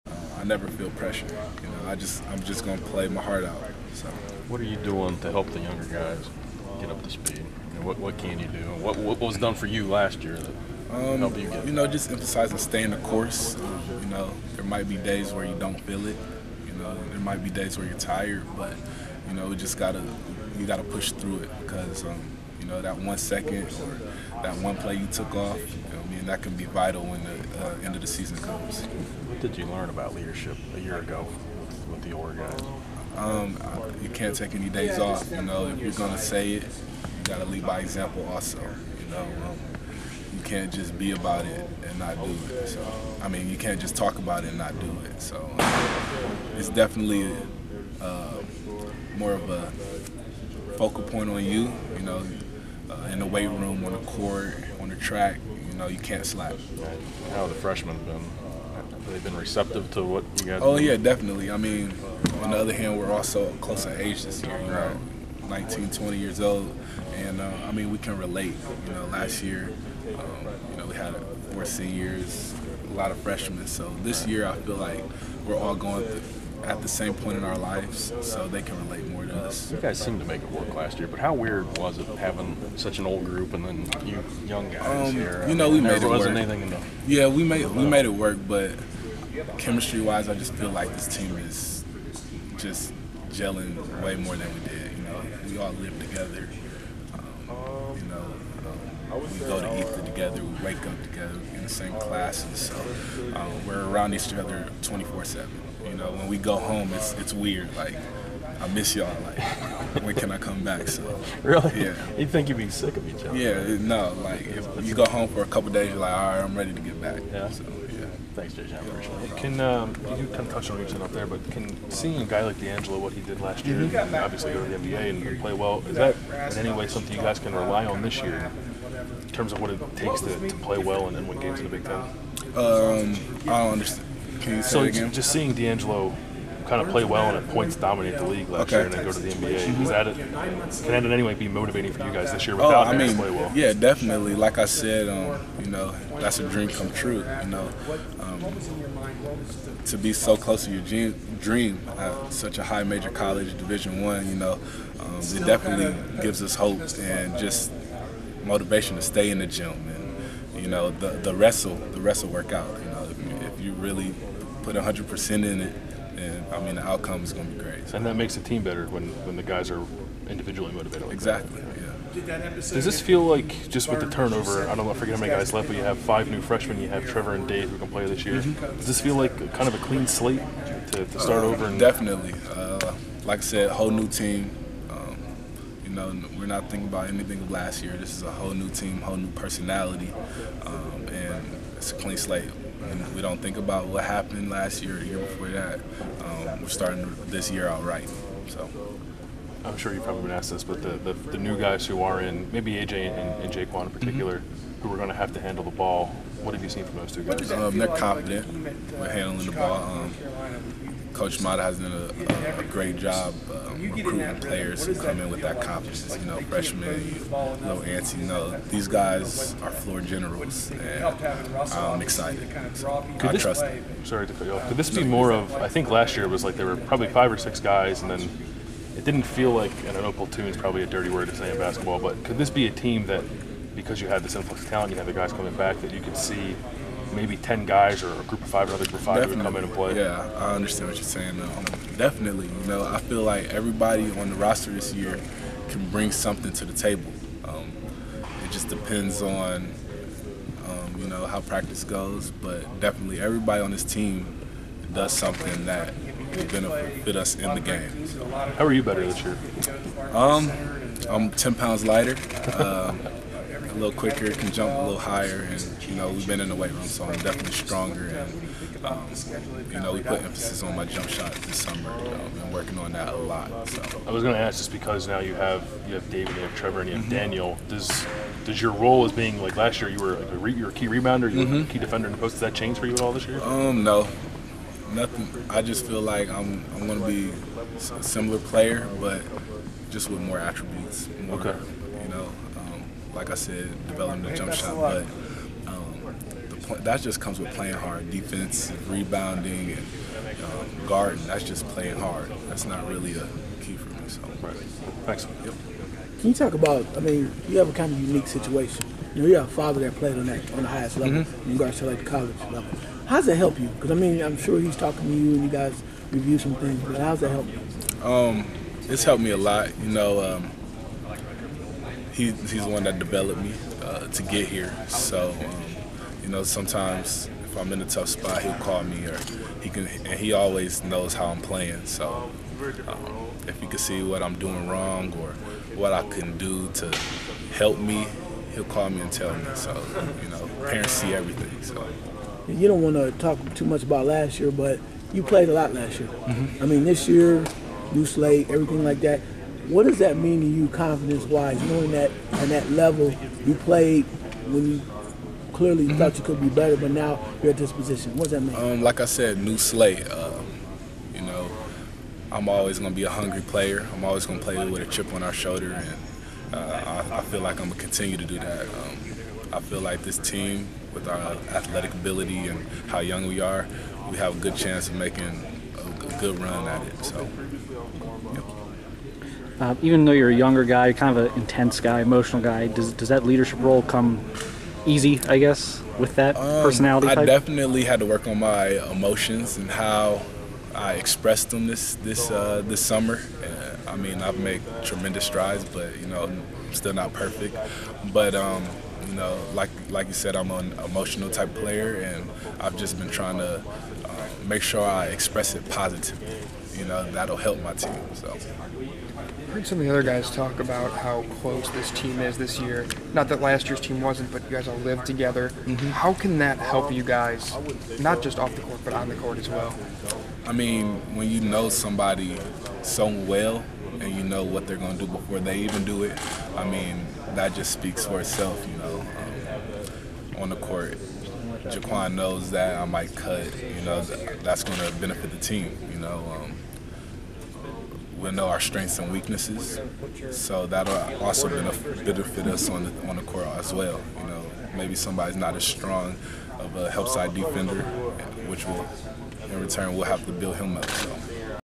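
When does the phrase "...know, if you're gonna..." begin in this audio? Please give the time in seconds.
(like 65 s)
35 s.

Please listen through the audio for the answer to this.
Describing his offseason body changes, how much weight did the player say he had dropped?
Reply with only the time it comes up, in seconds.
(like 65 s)
261 s.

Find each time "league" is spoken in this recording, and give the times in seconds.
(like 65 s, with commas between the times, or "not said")
138 s.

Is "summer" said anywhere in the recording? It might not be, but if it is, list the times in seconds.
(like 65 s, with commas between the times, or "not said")
271 s, 392 s.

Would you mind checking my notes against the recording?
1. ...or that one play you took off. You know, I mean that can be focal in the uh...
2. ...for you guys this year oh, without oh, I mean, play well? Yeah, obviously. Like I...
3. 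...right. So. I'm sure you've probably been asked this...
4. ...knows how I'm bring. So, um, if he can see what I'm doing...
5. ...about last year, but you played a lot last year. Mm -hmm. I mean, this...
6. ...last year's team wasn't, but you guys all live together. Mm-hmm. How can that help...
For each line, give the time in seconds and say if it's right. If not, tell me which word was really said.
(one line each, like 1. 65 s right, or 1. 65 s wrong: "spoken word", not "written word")
1. 23 s wrong: "vital", not "focal"
2. 141 s wrong: "definitely", not "obviously"
3. 197 s right
4. 330 s wrong: "playing", not "bring"
5. 343 s right
6. 413 s right.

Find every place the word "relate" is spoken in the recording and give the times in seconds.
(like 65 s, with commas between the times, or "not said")
68 s, 78 s.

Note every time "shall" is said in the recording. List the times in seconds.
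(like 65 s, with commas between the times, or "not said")
not said.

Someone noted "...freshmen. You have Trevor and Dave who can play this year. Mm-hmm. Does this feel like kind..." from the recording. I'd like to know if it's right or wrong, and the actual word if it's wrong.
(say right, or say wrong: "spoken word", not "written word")
right.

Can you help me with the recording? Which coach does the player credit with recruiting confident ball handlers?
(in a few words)
Coach Matta.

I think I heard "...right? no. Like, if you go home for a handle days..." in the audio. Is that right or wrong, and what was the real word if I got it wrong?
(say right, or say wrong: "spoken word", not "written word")
wrong: "couple", not "handle".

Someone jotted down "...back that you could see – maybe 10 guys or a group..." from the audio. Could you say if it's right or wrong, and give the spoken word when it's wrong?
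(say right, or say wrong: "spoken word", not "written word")
right.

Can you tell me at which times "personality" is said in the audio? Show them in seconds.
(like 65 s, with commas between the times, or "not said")
189 s, 386 s.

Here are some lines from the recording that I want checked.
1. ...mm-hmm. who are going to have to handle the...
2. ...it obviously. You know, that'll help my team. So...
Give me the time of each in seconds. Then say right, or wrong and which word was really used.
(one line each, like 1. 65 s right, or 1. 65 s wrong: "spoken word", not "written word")
1. 204 s right
2. 405 s wrong: "positively", not "obviously".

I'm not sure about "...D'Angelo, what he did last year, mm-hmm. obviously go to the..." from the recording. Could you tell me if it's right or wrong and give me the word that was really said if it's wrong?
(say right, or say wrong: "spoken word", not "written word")
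right.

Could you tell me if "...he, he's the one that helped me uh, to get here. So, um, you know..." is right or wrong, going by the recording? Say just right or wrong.
wrong.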